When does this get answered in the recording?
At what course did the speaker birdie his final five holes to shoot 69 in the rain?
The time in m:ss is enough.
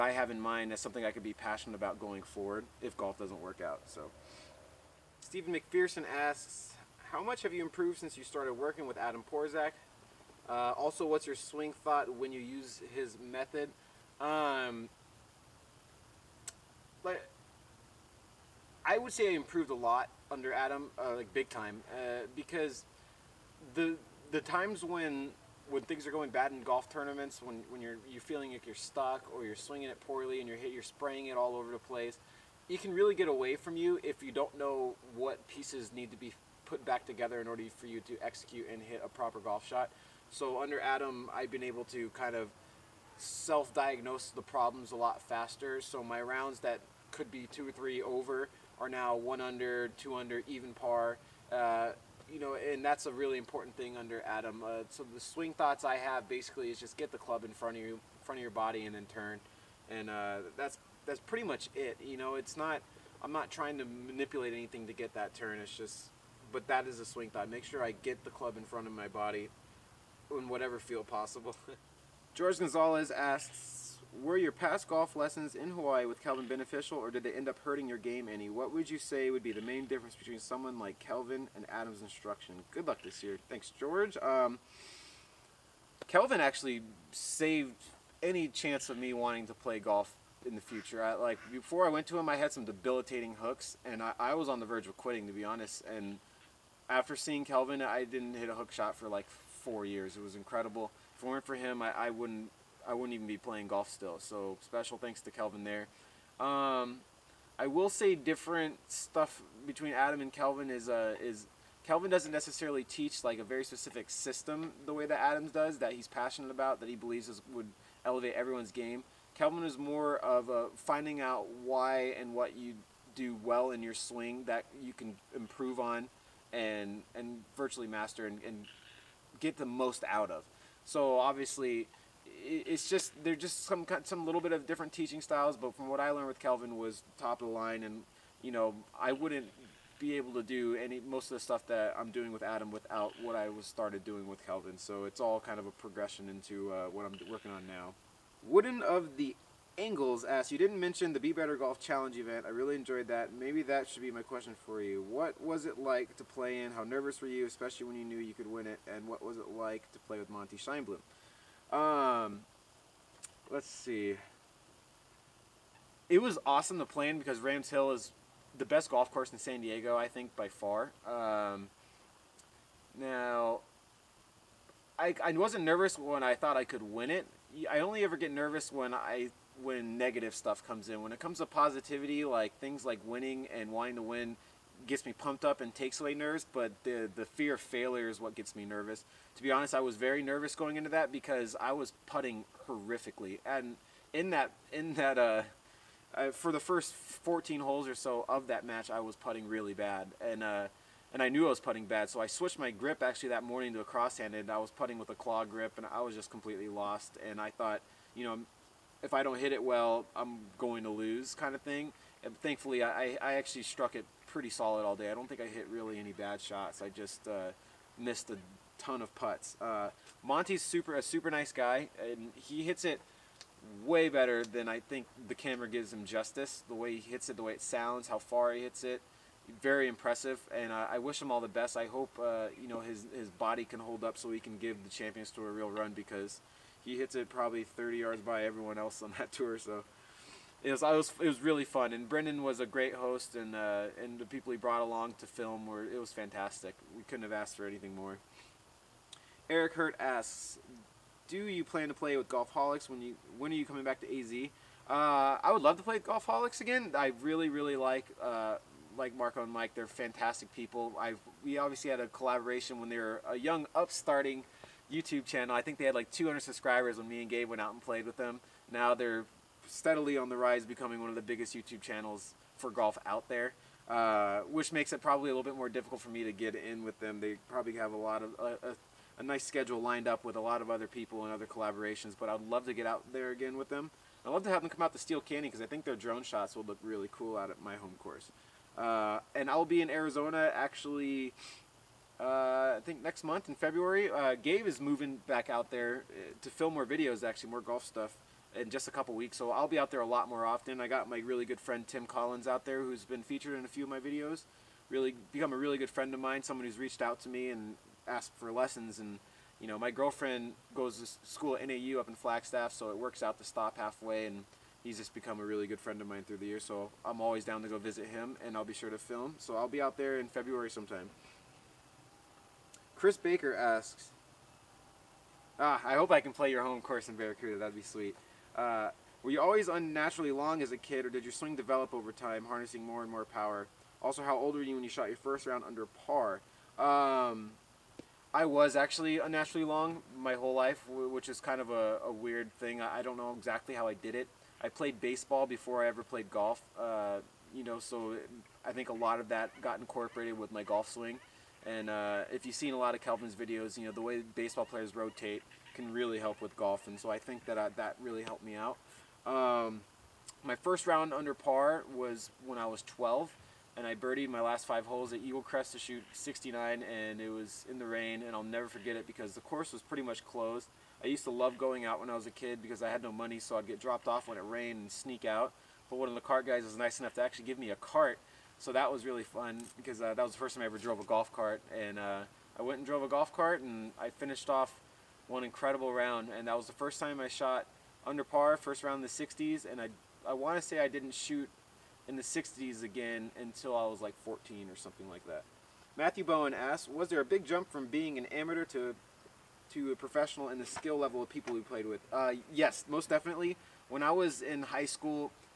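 6:05.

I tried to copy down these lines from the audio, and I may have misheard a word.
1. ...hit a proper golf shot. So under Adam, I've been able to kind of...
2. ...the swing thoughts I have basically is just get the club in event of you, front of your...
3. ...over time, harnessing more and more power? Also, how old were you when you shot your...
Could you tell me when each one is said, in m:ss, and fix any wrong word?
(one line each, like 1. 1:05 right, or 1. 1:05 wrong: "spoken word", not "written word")
1. 0:38 right
2. 0:55 wrong: "front", not "event"
3. 5:31 right.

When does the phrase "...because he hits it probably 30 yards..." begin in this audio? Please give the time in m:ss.
3:55.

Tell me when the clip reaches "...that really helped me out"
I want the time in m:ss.
5:57.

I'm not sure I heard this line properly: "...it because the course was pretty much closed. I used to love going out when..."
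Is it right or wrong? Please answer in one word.
right.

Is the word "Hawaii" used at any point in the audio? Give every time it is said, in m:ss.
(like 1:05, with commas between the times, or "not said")
1:15.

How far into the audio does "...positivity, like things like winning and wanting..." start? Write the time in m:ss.
3:01.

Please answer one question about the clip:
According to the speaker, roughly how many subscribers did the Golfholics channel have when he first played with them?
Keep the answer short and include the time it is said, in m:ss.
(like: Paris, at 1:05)
200, at 4:26.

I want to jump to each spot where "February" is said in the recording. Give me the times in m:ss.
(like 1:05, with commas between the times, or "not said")
4:53, 5:20.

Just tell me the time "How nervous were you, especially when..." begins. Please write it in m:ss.
2:36.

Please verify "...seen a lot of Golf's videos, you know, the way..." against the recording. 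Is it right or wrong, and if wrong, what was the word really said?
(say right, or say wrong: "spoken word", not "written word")
wrong: "Kelvin", not "Golf".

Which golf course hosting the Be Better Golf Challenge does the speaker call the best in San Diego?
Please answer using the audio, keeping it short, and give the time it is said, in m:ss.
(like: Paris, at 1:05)
Rams Hill, at 2:47.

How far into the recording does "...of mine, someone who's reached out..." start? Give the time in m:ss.
5:06.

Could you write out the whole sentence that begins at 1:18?
What would you say would be the main difference between someone like Kelvin and Adam's instruction?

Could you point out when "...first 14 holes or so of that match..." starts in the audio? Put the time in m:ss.
3:16.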